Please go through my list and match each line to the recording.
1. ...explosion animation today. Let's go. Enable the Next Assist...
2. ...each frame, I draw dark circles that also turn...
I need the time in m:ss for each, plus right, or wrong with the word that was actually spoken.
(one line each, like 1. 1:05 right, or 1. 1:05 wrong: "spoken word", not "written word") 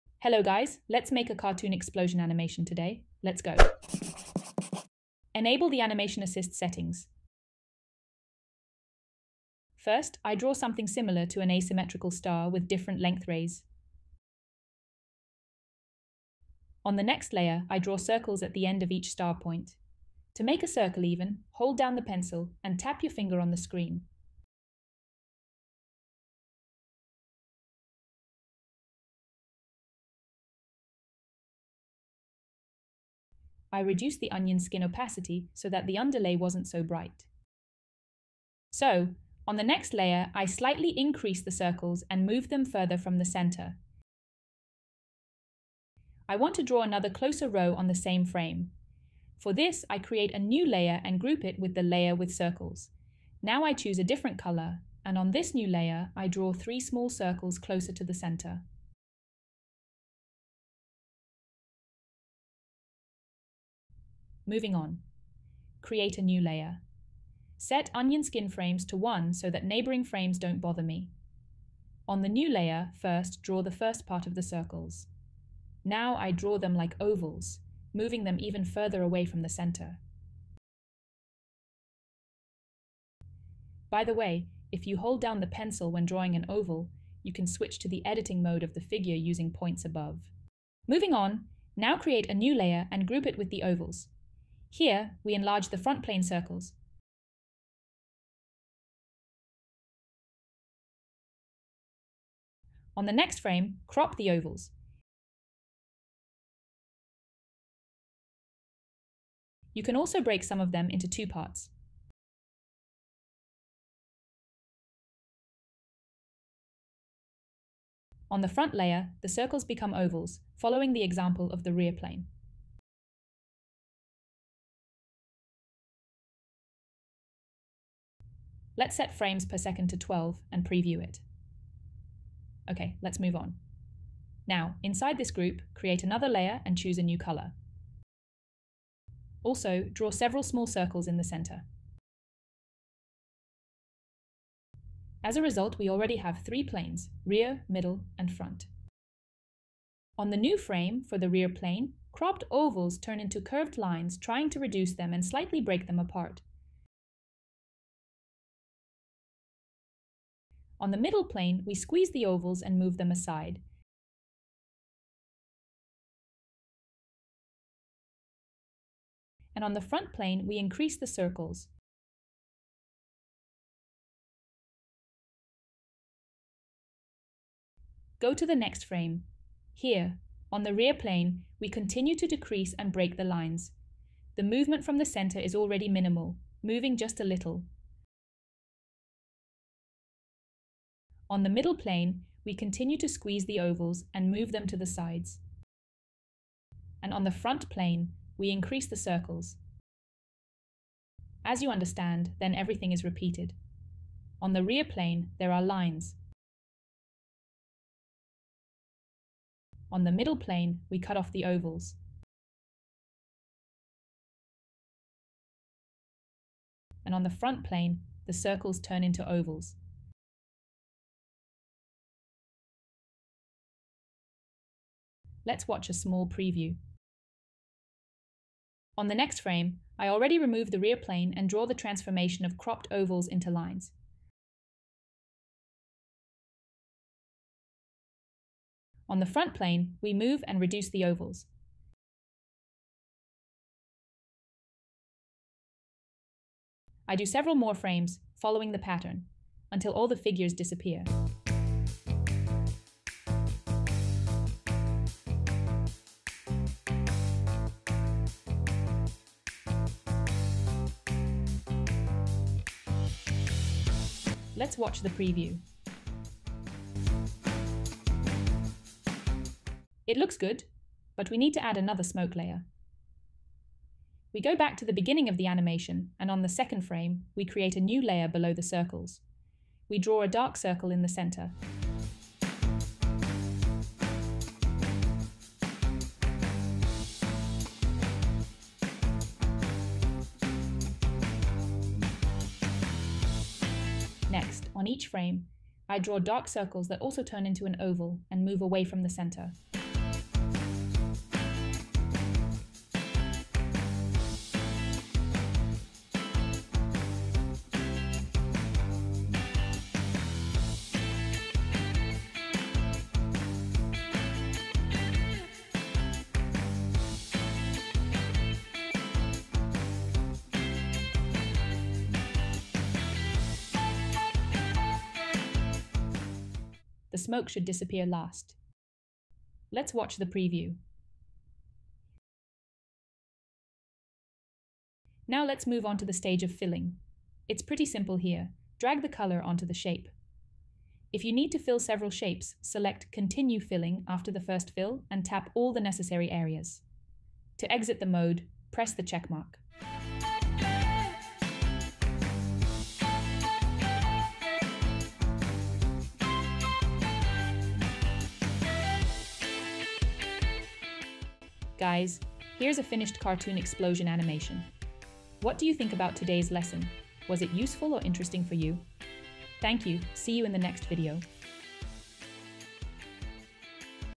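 1. 0:01 wrong: "Animation", not "Next"
2. 4:54 right.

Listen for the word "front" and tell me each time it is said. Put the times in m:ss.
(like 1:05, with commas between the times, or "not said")
1:35, 1:58, 2:28, 2:49, 3:17, 3:37, 3:59.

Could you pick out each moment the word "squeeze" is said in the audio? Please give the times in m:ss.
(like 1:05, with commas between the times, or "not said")
2:41, 3:13.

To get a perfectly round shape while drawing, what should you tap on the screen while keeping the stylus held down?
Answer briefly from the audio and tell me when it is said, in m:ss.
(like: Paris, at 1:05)
Your finger, at 0:22.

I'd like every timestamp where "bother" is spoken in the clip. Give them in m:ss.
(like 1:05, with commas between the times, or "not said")
1:10.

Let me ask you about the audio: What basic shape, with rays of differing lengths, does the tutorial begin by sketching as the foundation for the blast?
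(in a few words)
Asymmetrical star.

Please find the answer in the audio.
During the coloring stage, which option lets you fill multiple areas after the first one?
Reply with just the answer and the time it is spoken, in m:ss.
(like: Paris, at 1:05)
Continue Filling, at 5:43.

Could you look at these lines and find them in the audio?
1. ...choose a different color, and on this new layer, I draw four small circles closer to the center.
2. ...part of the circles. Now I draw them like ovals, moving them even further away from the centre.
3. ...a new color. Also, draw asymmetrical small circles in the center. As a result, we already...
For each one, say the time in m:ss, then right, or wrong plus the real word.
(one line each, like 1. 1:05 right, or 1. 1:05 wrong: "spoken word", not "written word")
1. 0:53 wrong: "three", not "four"
2. 1:14 right
3. 2:16 wrong: "several", not "asymmetrical".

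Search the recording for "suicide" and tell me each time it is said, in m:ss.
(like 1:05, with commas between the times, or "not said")
not said.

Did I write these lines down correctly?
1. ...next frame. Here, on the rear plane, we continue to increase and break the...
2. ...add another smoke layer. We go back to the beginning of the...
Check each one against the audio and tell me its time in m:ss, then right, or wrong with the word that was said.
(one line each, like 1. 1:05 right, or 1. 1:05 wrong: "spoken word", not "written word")
1. 2:58 wrong: "decrease", not "increase"
2. 4:31 right.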